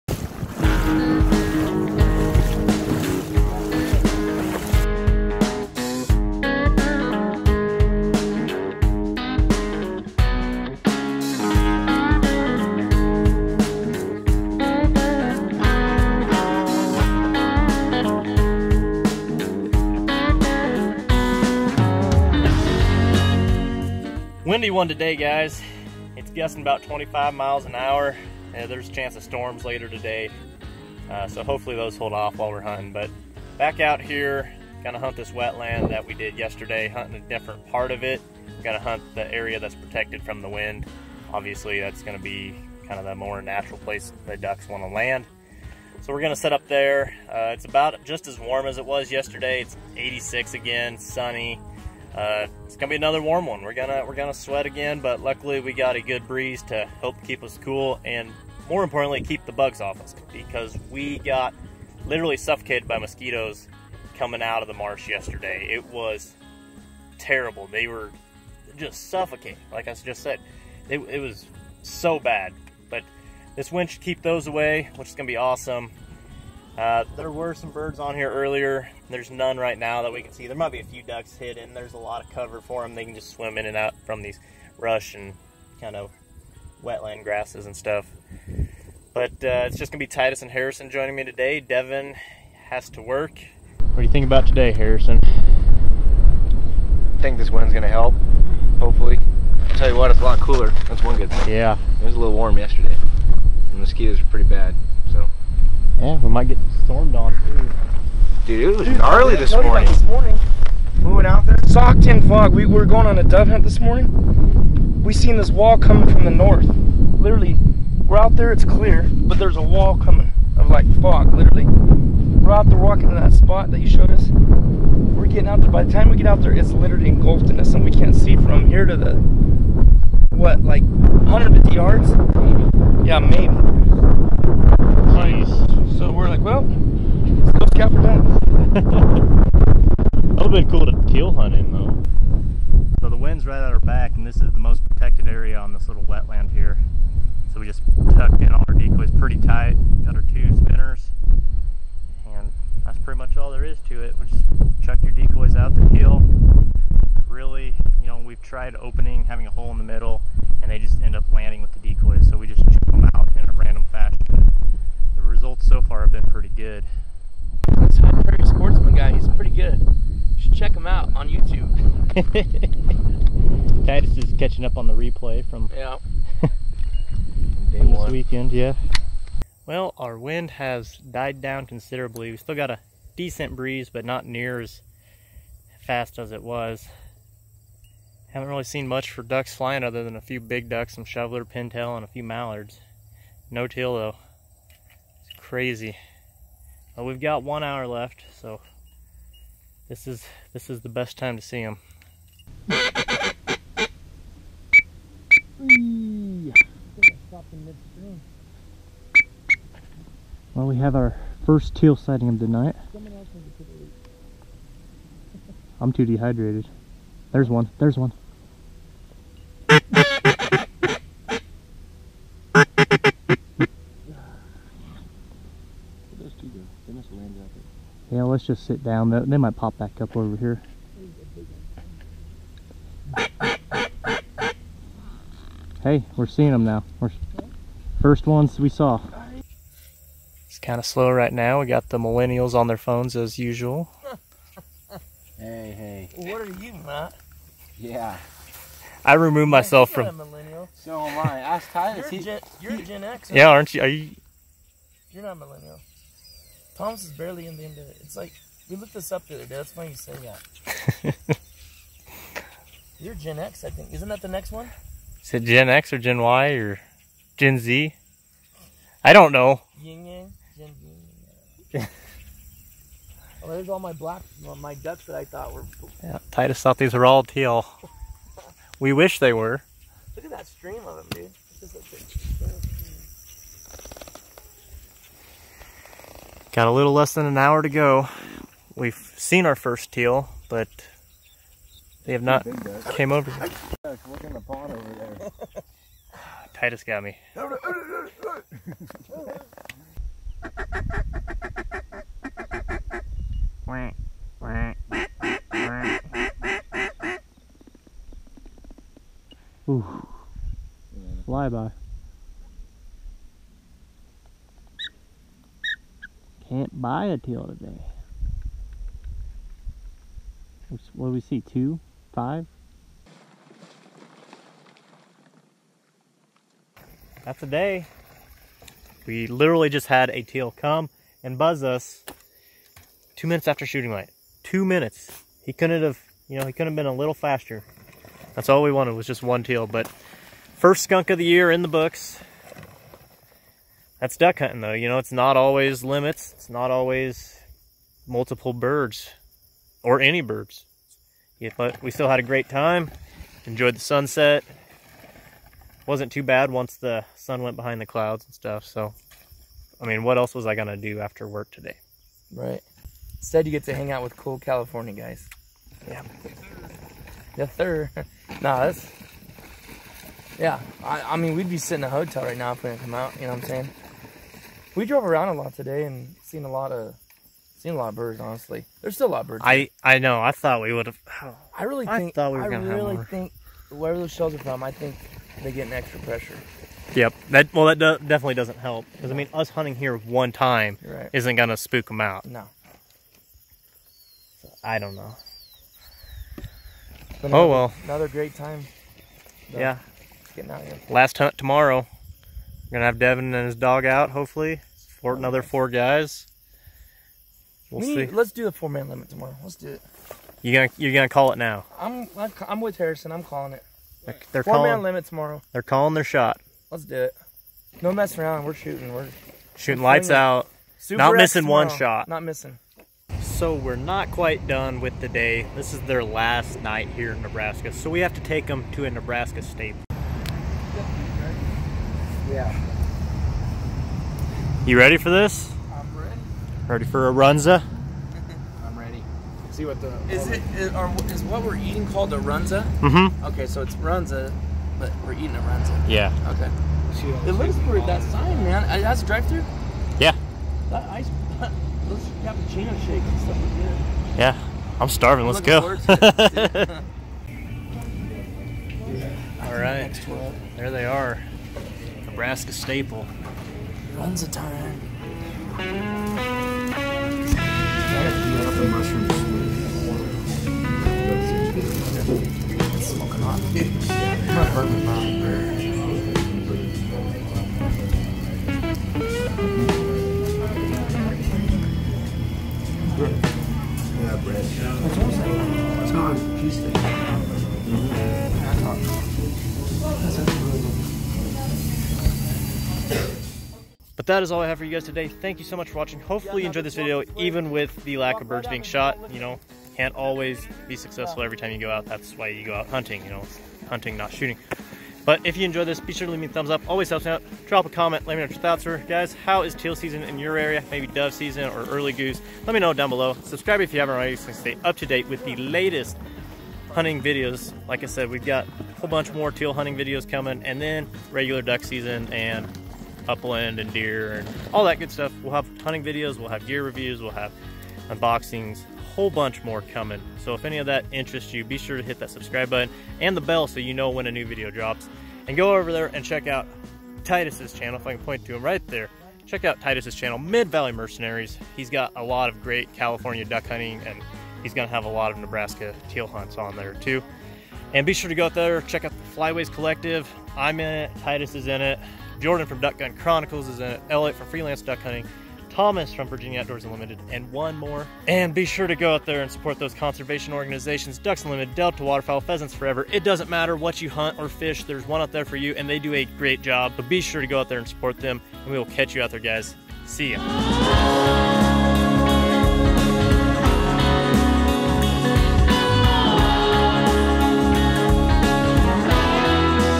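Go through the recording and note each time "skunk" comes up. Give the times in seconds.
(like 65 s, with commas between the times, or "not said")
340 s.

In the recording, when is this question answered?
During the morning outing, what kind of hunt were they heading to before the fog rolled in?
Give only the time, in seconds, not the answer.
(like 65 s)
113 s.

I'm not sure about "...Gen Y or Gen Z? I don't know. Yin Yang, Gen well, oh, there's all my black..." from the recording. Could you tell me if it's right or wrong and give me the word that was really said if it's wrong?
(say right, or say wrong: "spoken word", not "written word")
right.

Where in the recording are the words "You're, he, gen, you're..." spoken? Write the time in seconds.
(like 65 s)
251 s.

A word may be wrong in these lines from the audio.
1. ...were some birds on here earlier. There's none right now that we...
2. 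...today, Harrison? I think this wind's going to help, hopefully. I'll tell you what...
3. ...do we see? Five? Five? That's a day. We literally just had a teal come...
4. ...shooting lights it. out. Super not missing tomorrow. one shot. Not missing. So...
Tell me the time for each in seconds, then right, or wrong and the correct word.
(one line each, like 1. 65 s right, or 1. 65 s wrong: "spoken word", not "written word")
1. 77 s right
2. 94 s right
3. 321 s wrong: "Two", not "Five"
4. 419 s right.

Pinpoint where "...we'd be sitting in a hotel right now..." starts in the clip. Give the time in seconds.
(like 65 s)
371 s.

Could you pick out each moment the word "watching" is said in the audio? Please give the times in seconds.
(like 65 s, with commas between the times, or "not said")
495 s.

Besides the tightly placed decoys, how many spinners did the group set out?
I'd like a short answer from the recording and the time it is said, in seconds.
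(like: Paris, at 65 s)
2, at 150 s.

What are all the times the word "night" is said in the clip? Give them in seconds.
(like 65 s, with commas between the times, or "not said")
212 s, 426 s.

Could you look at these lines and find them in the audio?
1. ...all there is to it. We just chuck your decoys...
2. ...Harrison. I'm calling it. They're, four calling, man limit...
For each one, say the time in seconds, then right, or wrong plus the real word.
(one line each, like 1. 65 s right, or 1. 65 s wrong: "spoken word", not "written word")
1. 153 s right
2. 412 s right.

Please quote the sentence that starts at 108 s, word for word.
Dude, it was Dude, gnarly this morning.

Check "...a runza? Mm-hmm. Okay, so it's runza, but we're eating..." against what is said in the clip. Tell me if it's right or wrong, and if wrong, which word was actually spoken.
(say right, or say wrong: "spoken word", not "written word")
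right.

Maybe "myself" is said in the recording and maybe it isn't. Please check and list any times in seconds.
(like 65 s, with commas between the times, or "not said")
249 s.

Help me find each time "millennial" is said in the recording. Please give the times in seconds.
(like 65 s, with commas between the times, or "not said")
241 s, 250 s, 255 s.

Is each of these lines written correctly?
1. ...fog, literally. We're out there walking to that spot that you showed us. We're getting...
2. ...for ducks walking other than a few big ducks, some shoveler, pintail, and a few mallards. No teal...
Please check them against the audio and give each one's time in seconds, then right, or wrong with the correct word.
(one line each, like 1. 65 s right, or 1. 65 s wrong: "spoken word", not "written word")
1. 121 s right
2. 189 s wrong: "flying", not "walking".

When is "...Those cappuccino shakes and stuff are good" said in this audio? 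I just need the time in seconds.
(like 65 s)
451 s.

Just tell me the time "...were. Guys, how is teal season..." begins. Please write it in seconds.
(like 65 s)
508 s.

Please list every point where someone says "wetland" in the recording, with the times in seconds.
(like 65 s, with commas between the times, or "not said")
35 s, 86 s, 146 s.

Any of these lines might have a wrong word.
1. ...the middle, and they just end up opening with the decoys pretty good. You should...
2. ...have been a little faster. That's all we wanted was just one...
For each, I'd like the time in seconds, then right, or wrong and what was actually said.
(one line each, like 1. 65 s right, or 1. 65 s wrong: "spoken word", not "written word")
1. 159 s wrong: "landing", not "opening"
2. 336 s right.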